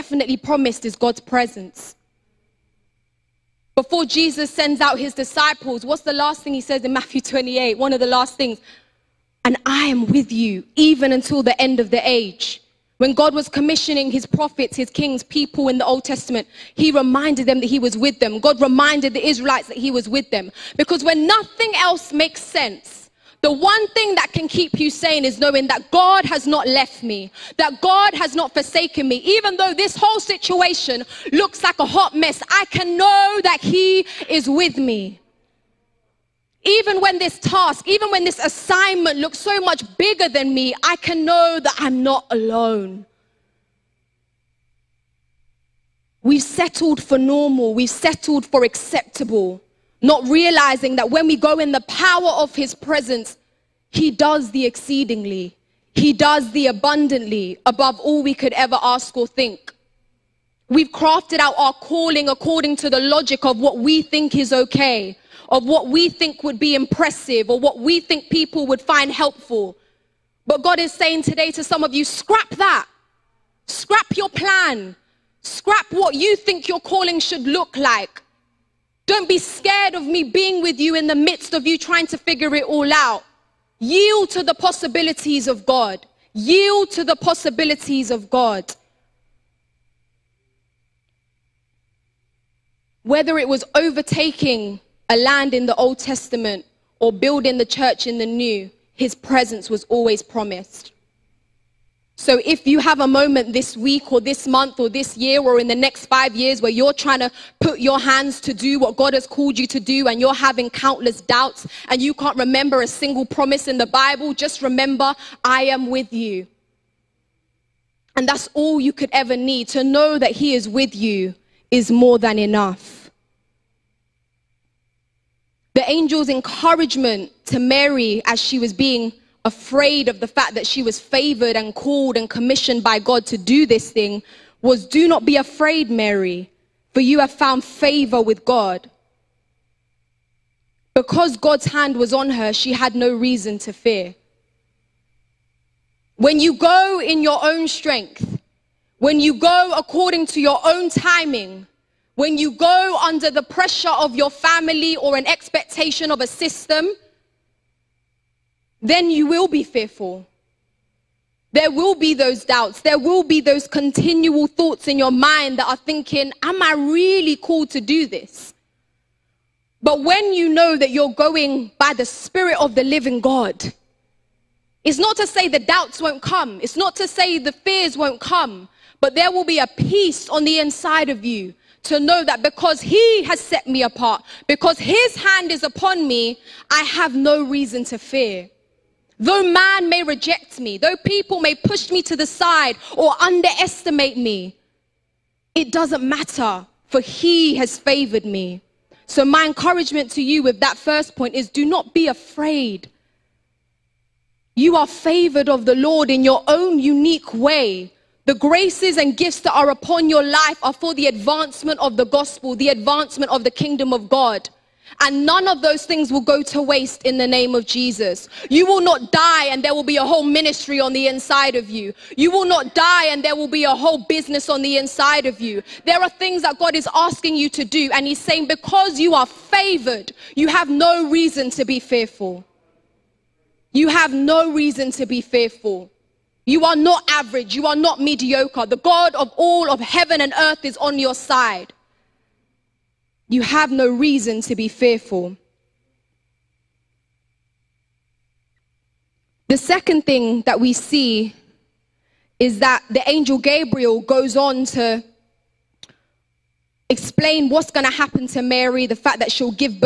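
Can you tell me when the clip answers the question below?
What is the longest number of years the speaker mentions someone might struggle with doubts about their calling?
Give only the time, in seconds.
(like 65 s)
106 s.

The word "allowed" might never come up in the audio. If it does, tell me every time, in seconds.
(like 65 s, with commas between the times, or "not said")
not said.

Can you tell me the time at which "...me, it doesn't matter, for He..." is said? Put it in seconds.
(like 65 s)
194 s.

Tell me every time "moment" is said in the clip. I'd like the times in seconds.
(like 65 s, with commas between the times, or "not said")
103 s.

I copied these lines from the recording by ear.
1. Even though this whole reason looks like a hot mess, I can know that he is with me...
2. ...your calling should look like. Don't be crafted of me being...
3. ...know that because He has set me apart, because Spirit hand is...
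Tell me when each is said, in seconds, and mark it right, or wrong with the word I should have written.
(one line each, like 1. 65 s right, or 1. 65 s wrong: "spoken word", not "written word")
1. 29 s wrong: "situation", not "reason"
2. 76 s wrong: "scared", not "crafted"
3. 181 s wrong: "His", not "Spirit".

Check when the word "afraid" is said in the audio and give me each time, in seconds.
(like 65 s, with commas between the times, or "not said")
129 s, 135 s, 202 s.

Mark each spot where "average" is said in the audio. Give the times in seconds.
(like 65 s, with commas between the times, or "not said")
237 s.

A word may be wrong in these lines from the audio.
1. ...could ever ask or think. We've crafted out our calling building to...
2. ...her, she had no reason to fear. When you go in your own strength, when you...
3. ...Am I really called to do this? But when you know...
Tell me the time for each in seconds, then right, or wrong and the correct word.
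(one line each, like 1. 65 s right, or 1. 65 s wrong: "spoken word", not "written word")
1. 58 s wrong: "according", not "building"
2. 142 s right
3. 166 s right.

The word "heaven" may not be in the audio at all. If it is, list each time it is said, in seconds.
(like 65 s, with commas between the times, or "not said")
239 s.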